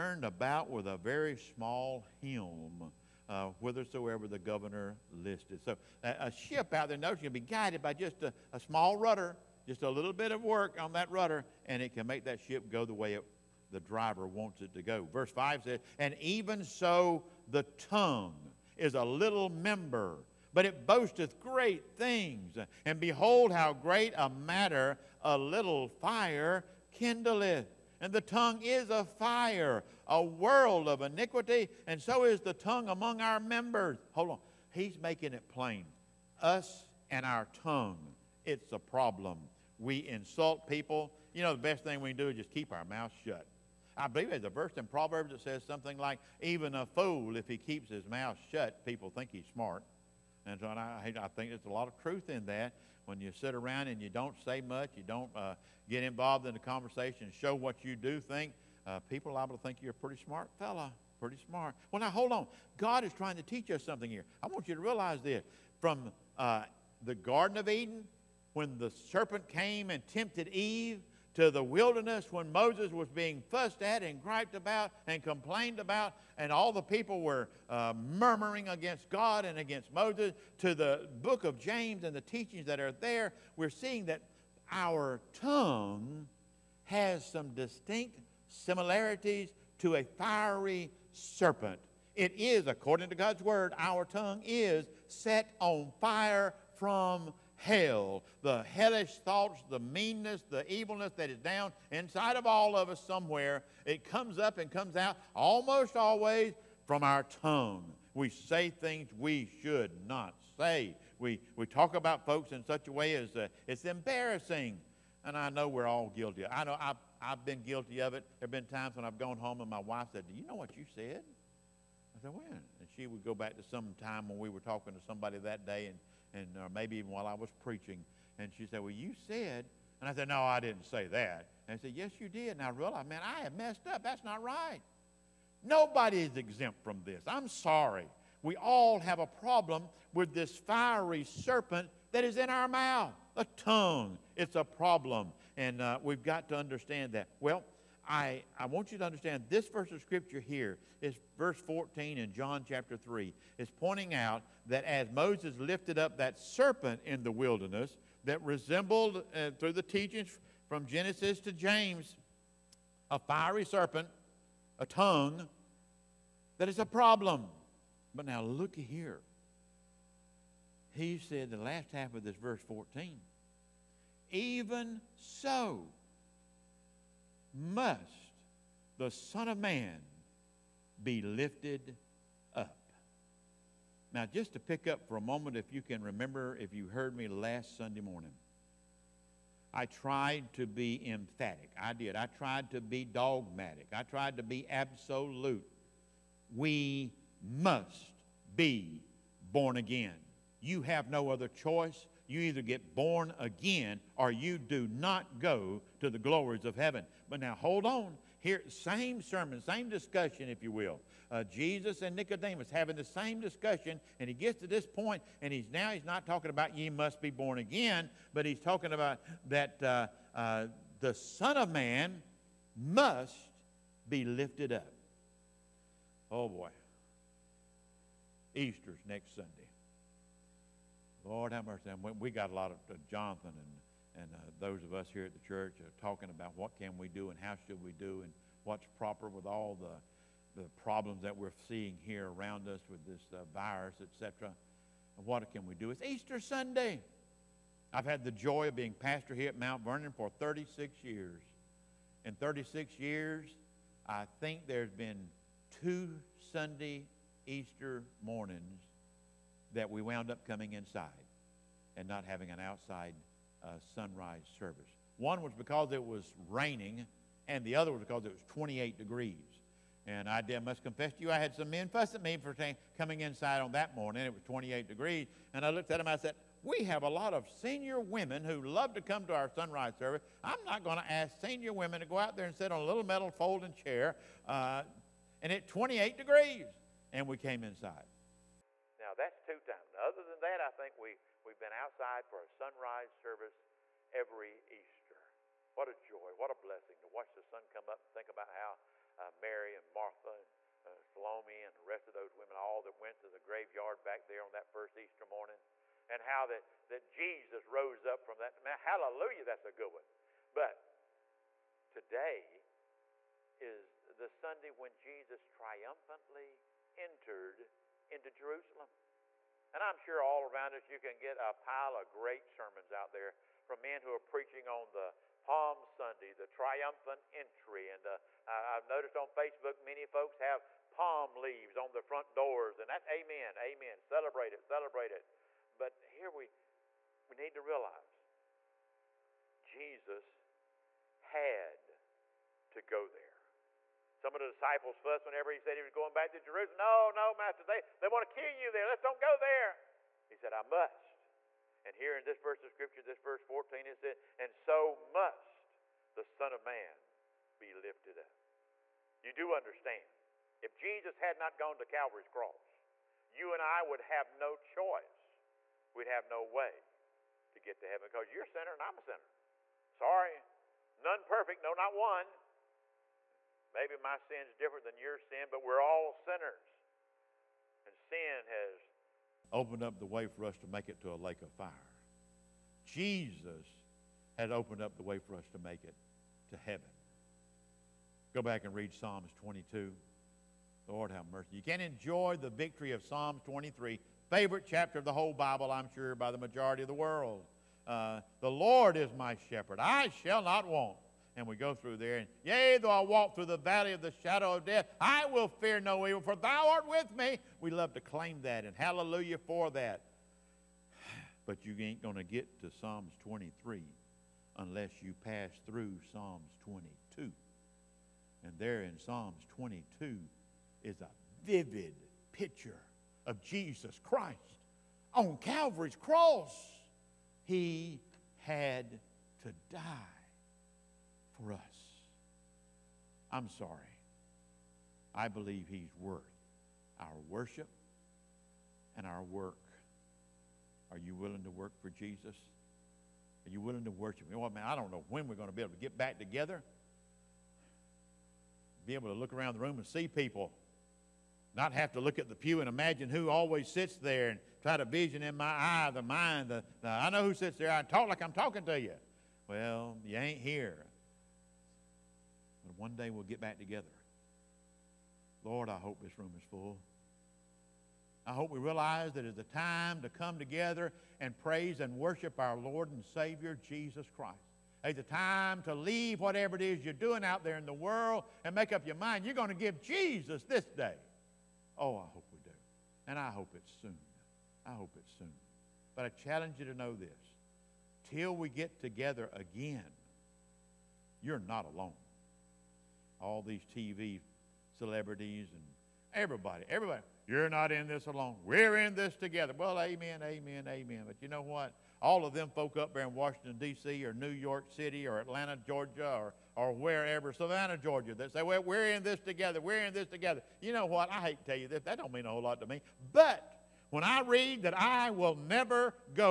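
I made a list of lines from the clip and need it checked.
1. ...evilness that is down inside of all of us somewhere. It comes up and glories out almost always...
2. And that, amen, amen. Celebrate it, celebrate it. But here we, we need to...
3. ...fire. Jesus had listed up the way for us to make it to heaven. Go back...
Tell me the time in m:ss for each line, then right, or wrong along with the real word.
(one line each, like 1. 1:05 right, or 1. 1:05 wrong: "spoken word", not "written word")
1. 1:40 wrong: "comes", not "glories"
2. 5:32 right
3. 6:21 wrong: "opened", not "listed".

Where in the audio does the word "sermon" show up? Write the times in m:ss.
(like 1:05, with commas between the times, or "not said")
3:29, 5:22.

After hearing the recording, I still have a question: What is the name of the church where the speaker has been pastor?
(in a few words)
Mount Vernon.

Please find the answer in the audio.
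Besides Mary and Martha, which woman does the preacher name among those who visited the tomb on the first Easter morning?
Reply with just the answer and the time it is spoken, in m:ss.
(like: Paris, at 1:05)
Salome, at 5:01.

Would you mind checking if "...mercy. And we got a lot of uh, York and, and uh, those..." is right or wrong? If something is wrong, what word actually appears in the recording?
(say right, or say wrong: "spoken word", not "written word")
wrong: "Jonathan", not "York".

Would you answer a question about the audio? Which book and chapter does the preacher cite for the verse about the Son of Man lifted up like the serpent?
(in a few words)
John chapter 3.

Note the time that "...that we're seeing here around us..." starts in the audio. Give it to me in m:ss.
4:01.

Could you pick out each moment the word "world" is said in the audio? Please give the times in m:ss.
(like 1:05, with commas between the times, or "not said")
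0:30, 6:36, 7:57.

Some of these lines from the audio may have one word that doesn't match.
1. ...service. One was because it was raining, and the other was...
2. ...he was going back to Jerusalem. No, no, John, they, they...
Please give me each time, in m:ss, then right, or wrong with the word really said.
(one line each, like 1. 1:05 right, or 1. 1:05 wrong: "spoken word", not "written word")
1. 4:24 right
2. 5:45 wrong: "Master", not "John".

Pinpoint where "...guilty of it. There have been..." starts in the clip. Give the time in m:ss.
1:57.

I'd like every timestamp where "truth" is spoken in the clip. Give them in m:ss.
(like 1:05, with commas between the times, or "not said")
0:52.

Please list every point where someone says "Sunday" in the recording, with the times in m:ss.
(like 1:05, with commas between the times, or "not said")
3:07, 3:49, 4:06, 4:16, 5:14, 5:25.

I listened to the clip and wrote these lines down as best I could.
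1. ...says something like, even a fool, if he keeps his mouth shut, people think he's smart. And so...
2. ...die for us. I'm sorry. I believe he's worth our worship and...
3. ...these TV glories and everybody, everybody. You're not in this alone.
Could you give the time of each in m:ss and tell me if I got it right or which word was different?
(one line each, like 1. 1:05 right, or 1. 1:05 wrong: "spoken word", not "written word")
1. 0:45 right
2. 7:09 right
3. 8:13 wrong: "celebrities", not "glories".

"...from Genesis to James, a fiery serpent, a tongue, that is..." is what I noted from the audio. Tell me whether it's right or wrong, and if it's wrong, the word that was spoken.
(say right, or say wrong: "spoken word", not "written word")
right.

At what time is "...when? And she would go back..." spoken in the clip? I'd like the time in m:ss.
2:02.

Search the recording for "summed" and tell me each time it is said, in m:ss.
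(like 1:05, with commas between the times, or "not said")
not said.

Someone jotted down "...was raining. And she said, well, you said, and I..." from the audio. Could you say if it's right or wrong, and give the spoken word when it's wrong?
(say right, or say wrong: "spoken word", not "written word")
wrong: "preaching", not "raining".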